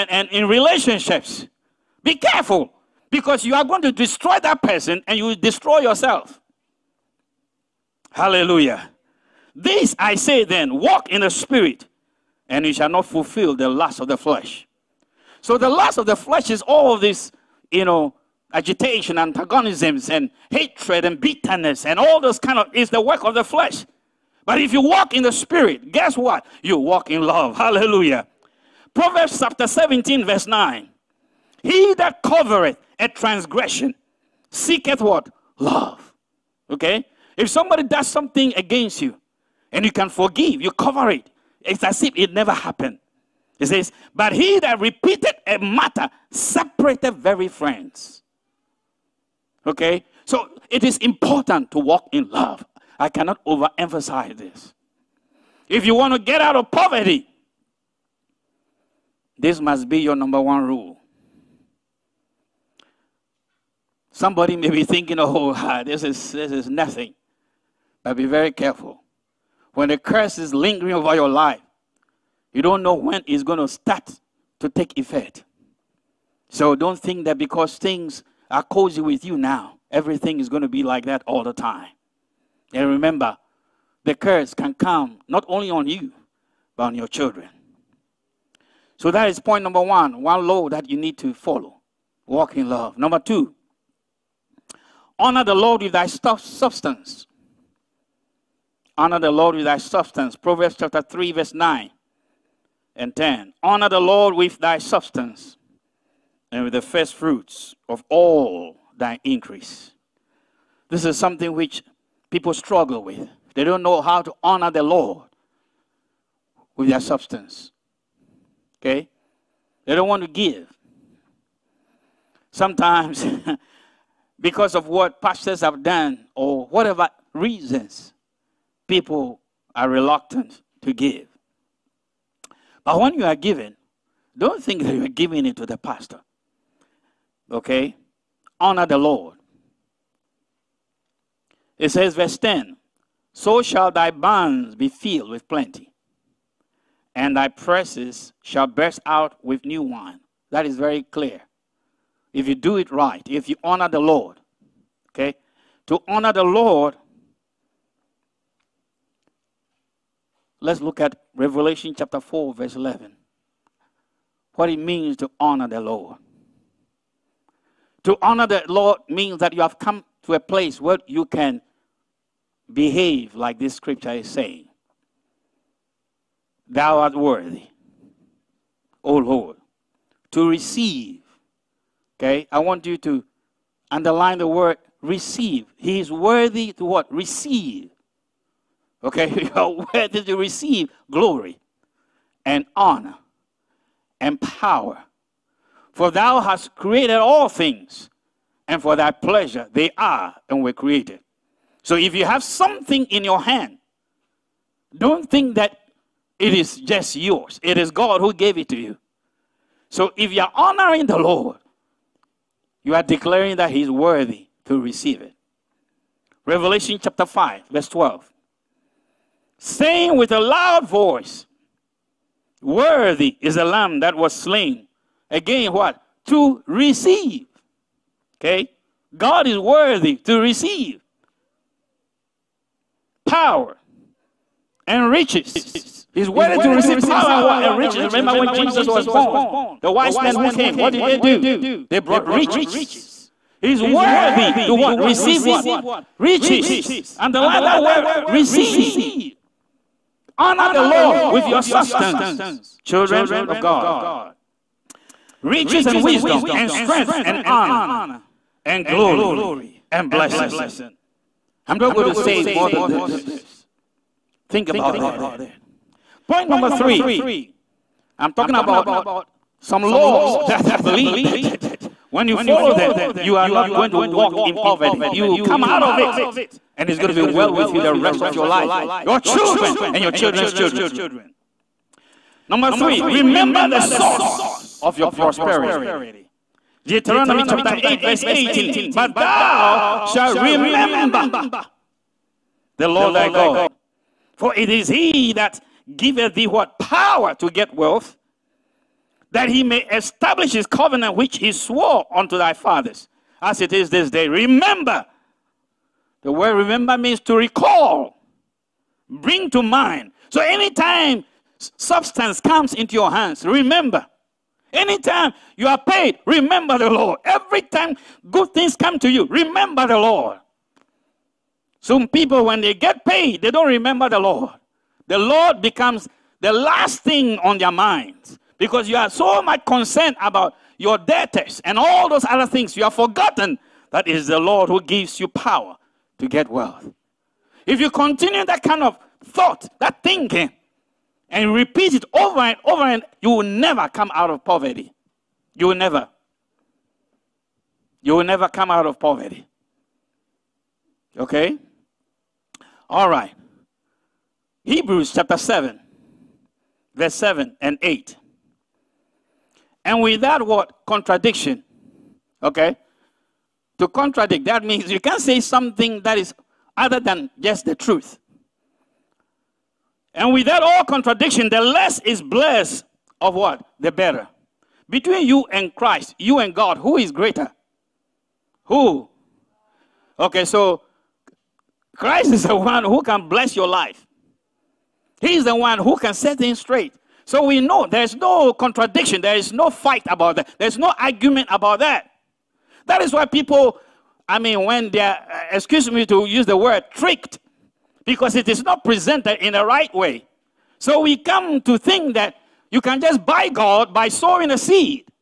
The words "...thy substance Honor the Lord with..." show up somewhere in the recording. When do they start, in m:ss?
1:35.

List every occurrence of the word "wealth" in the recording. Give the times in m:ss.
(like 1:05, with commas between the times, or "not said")
4:57, 5:36.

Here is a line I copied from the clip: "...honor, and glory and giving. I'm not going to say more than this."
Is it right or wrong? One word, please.
wrong.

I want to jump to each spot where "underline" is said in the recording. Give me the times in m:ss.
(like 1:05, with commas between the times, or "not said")
3:03, 4:07.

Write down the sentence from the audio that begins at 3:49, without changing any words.
God is worthy to receive power and riches.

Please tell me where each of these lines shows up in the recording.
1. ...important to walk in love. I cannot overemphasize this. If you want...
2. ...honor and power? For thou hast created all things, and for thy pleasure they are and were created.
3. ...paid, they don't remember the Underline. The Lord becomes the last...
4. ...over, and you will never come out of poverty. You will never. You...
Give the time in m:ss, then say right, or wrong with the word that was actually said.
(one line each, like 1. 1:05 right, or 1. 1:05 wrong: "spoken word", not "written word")
1. 0:50 right
2. 3:12 right
3. 5:23 wrong: "Lord", not "Underline"
4. 5:42 right.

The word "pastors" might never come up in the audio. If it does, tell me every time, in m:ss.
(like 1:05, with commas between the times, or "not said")
2:05, 2:15.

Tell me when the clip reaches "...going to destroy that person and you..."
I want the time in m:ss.
0:03.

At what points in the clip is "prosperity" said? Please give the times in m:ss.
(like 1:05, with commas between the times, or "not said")
4:45.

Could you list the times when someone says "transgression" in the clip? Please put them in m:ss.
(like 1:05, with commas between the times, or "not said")
0:33.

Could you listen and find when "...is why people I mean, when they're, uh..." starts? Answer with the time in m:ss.
6:33.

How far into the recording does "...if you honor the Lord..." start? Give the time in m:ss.
2:33.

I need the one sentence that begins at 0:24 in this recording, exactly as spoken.
But if you walk in the spirit, guess what?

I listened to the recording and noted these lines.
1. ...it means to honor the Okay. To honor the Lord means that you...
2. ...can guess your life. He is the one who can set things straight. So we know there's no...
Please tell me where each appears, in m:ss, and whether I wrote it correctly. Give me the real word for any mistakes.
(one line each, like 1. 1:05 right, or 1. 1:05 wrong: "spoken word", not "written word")
1. 2:44 wrong: "Lord", not "Okay"
2. 6:23 wrong: "bless", not "guess".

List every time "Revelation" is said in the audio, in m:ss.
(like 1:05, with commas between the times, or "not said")
2:41, 3:36.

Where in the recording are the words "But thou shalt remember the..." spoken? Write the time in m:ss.
4:48.